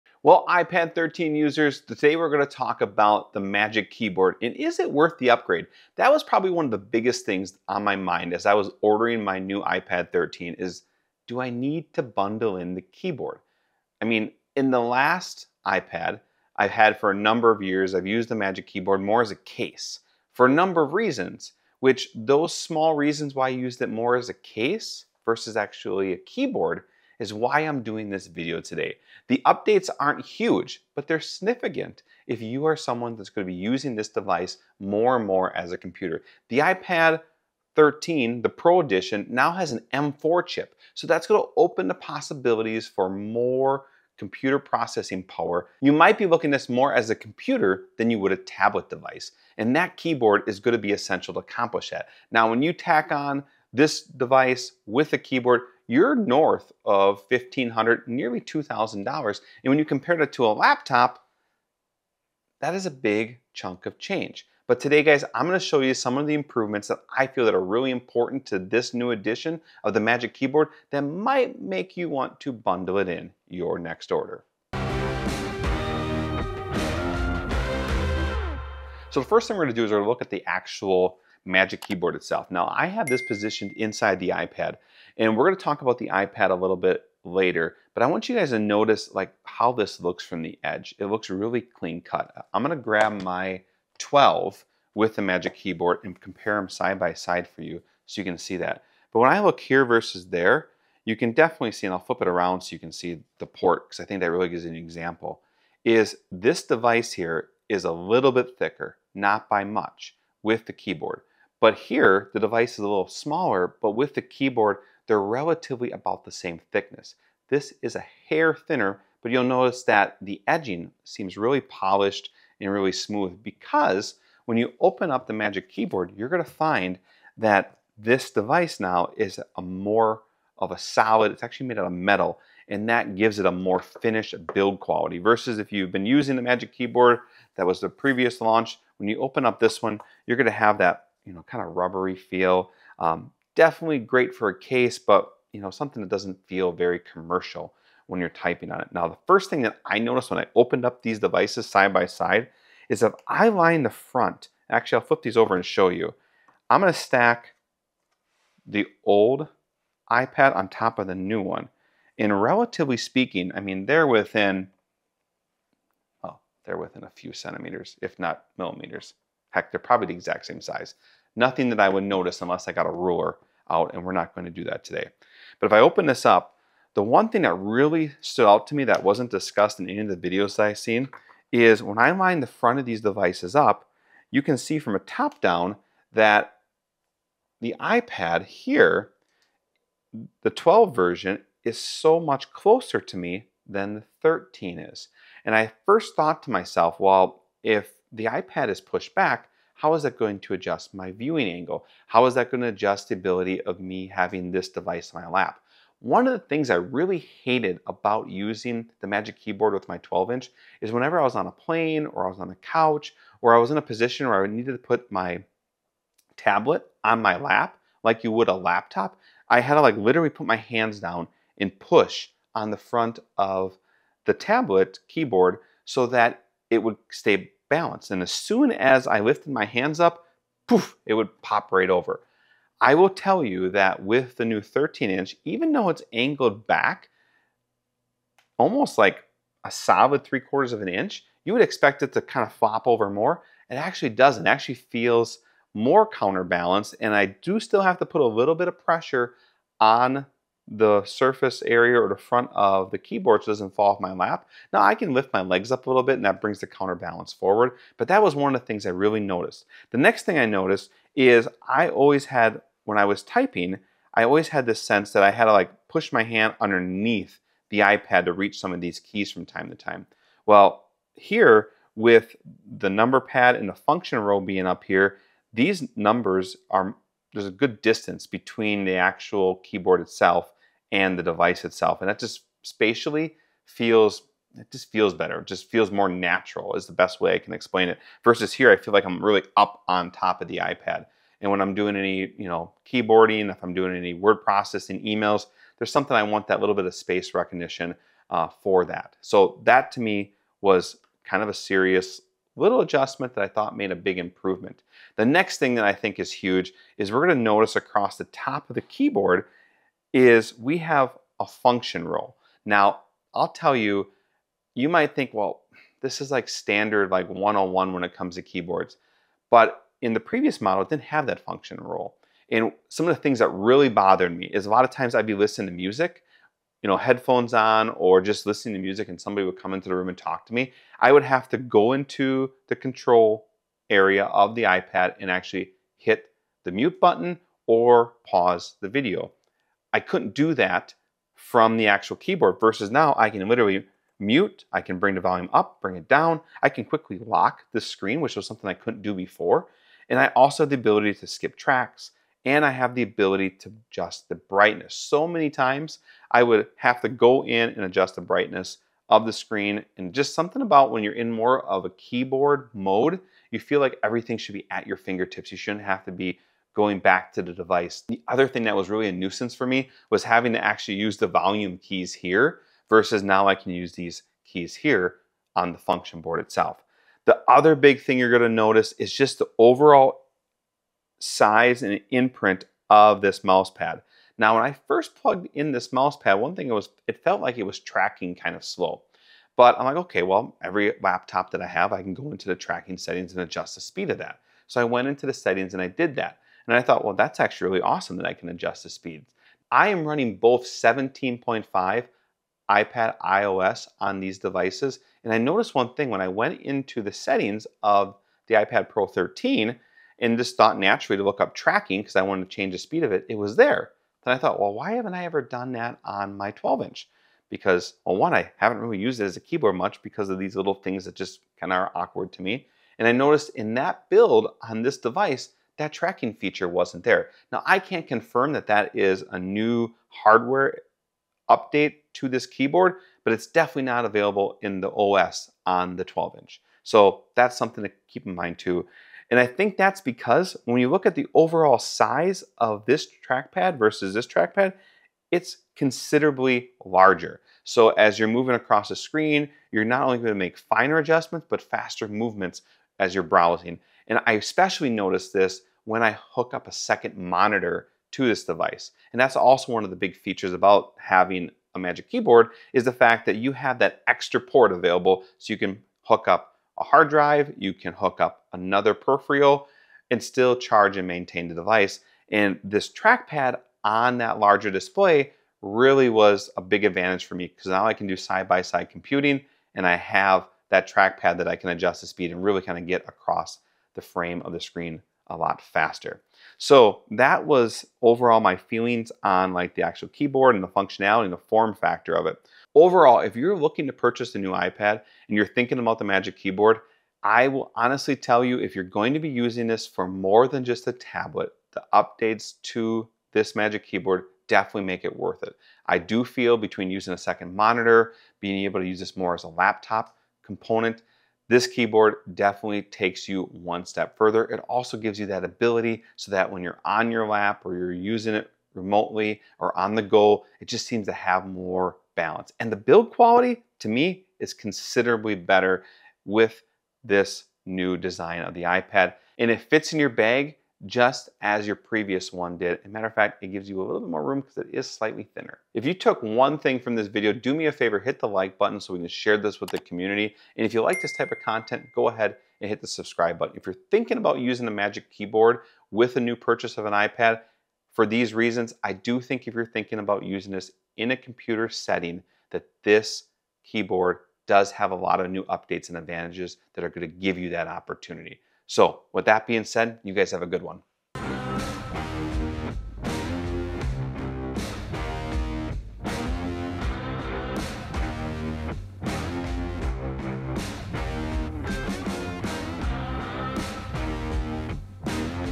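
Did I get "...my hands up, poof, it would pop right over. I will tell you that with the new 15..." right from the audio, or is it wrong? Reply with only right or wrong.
wrong.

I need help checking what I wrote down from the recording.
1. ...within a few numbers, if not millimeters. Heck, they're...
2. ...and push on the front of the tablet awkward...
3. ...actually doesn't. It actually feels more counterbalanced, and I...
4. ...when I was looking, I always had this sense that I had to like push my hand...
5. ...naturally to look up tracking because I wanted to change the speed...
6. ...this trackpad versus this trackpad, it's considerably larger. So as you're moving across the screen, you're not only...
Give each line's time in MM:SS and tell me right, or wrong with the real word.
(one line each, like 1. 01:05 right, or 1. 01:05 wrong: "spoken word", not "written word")
1. 02:46 wrong: "centimeters", not "numbers"
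2. 03:41 wrong: "keyboard", not "awkward"
3. 04:03 right
4. 04:22 wrong: "typing", not "looking"
5. 06:50 right
6. 07:22 right.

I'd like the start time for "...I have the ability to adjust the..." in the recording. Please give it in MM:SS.
05:52.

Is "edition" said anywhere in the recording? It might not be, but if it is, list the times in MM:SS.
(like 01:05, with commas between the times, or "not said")
00:38, 01:09.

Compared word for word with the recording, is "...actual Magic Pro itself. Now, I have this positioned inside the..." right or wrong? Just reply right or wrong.
wrong.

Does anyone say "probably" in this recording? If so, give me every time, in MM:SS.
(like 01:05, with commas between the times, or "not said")
00:06, 02:49.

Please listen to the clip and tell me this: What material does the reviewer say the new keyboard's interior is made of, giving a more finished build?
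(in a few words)
metal.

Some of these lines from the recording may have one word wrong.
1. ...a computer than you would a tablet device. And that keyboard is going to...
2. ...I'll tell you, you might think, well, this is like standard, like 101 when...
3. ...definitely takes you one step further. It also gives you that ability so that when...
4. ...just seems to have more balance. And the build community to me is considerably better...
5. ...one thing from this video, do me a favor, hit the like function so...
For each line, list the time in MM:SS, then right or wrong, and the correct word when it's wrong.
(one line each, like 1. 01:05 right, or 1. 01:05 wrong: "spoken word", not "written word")
1. 00:47 right
2. 05:13 right
3. 08:32 right
4. 08:40 wrong: "quality", not "community"
5. 08:56 wrong: "button", not "function".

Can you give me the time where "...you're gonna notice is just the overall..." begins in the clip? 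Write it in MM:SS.
06:18.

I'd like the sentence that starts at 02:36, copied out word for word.
I'm gonna stack the old iPad on top of the new one.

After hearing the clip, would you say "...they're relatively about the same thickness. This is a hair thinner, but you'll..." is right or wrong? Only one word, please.
right.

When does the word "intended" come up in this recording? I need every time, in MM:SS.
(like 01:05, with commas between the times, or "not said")
not said.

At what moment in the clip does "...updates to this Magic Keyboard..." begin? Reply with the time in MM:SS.
08:21.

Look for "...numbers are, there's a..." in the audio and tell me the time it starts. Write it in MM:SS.
04:35.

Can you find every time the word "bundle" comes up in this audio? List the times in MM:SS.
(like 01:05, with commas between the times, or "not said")
00:12, 01:12.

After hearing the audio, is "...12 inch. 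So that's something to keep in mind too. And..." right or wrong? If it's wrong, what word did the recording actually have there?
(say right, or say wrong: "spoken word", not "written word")
right.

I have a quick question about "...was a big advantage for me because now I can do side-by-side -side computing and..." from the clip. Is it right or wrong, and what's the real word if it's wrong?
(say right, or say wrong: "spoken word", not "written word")
right.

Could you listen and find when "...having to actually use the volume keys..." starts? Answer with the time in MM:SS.
06:10.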